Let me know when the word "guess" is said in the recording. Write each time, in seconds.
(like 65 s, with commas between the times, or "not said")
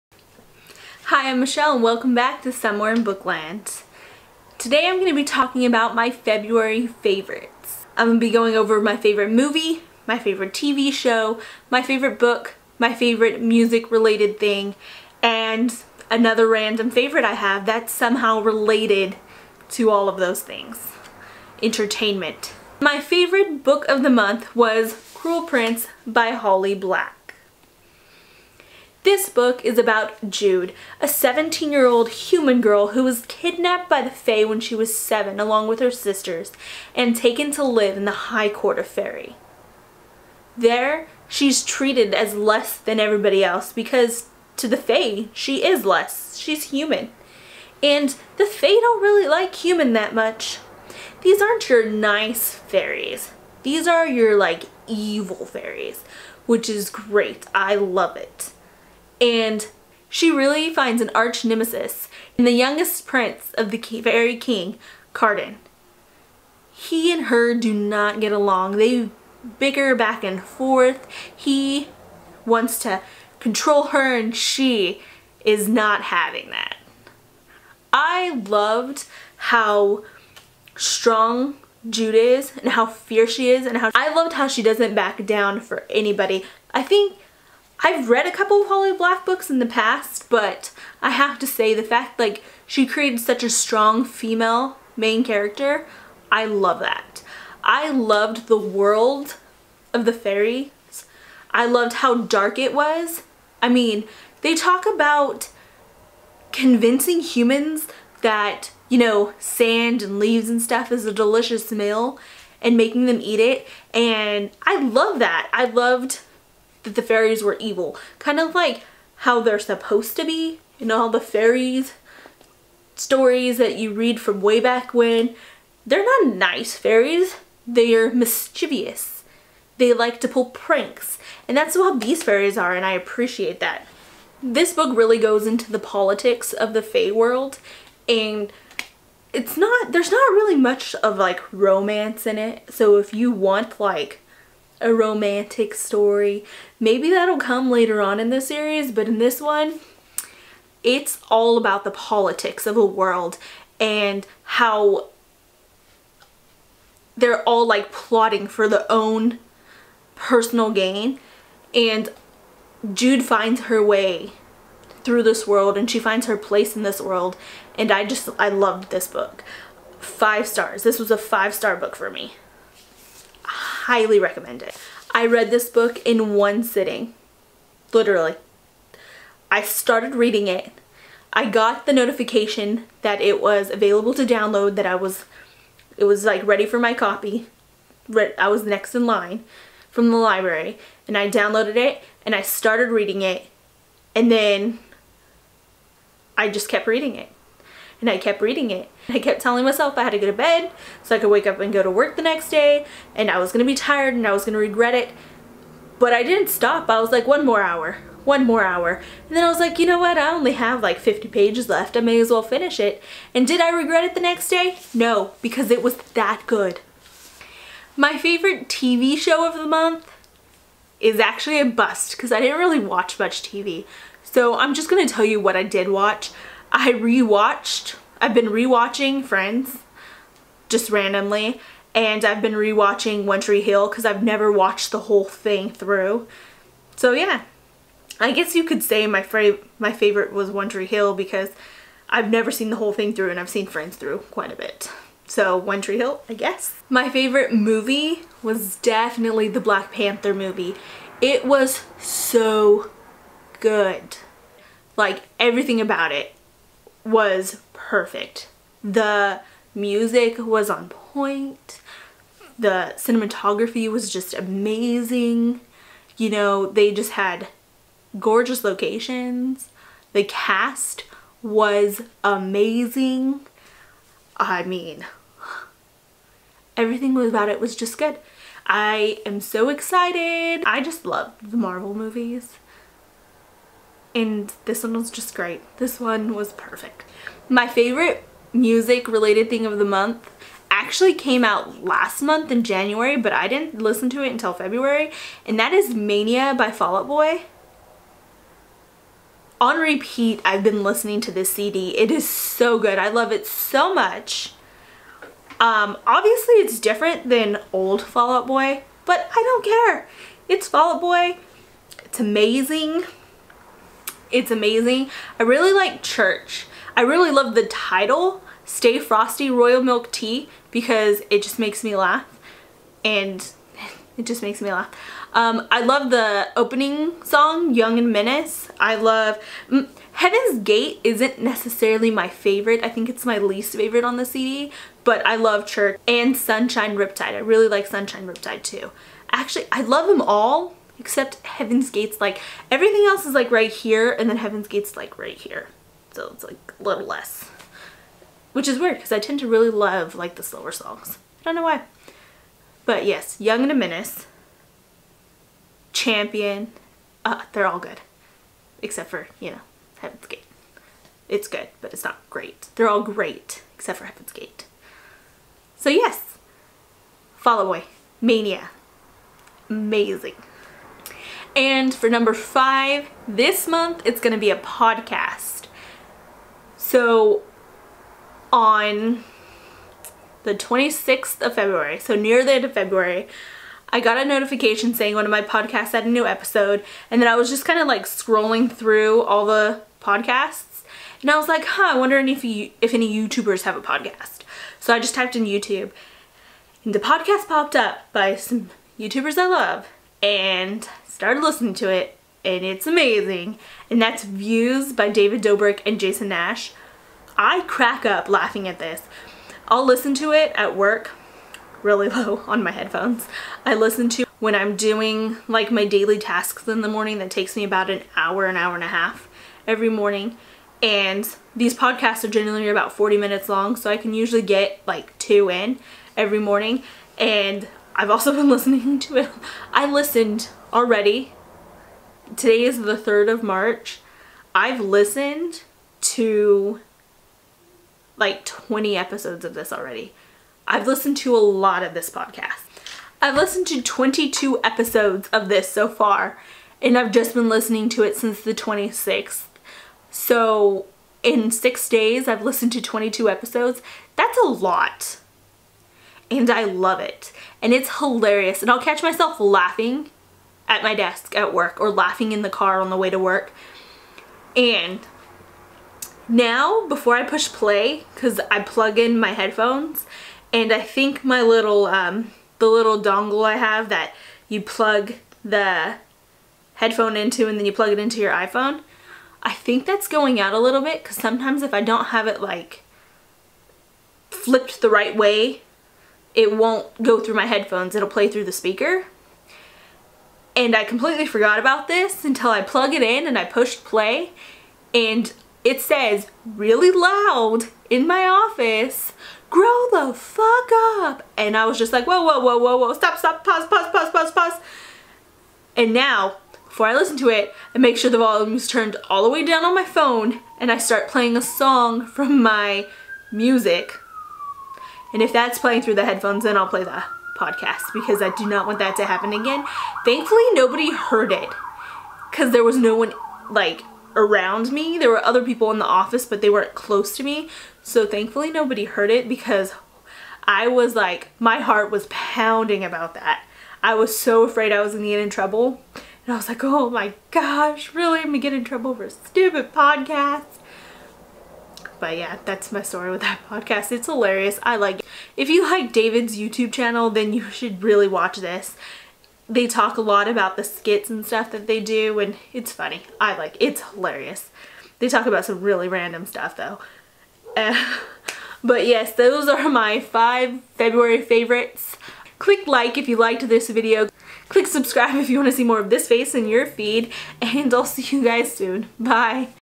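238 s, 246 s.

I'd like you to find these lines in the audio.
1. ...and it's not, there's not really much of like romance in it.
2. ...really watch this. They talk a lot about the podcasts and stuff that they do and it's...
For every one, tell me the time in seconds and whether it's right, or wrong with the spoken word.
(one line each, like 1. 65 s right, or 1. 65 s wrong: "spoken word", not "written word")
1. 138 s right
2. 547 s wrong: "skits", not "podcasts".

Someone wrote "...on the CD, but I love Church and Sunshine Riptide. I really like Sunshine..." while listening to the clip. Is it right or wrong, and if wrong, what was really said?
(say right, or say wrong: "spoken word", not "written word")
right.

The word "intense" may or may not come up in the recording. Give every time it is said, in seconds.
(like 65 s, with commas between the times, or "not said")
not said.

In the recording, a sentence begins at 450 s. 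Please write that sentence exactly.
So, in six days, I've listened to 22 episodes.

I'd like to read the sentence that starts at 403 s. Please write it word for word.
And that's Views by David Dobrik and Jason Nash.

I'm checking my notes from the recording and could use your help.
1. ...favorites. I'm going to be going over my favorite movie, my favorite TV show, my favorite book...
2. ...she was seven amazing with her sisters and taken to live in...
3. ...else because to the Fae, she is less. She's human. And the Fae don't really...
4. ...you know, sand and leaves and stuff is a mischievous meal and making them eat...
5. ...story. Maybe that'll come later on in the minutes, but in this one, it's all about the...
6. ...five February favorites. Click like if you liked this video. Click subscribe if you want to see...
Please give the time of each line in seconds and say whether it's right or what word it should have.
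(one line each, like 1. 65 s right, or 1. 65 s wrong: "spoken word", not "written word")
1. 6 s right
2. 34 s wrong: "along", not "amazing"
3. 43 s right
4. 108 s wrong: "delicious", not "mischievous"
5. 145 s wrong: "series", not "minutes"
6. 559 s right.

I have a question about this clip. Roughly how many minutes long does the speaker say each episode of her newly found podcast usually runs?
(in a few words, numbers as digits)
40 minutes.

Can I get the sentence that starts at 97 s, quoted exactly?
I loved the world of the fairies.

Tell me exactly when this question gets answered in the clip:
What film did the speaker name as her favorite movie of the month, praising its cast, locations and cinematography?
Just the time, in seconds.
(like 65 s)
249 s.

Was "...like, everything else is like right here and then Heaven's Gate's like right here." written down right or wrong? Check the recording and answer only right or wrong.
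right.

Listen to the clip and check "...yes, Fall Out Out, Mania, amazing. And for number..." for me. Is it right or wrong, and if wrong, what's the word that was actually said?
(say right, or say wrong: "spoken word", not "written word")
wrong: "Boy", not "Out".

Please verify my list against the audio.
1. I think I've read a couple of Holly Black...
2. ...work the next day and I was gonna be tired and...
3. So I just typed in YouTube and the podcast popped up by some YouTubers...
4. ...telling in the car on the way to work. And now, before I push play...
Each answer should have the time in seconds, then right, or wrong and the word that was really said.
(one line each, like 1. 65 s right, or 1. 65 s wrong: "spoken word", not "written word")
1. 86 s right
2. 201 s right
3. 394 s right
4. 461 s wrong: "laughing", not "telling".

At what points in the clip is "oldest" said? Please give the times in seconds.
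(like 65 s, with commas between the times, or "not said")
not said.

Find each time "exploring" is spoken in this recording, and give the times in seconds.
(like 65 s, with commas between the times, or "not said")
not said.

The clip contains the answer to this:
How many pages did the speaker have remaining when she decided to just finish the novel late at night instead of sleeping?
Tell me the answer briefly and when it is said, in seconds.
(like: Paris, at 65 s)
50, at 210 s.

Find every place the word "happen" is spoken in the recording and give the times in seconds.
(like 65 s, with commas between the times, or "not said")
519 s.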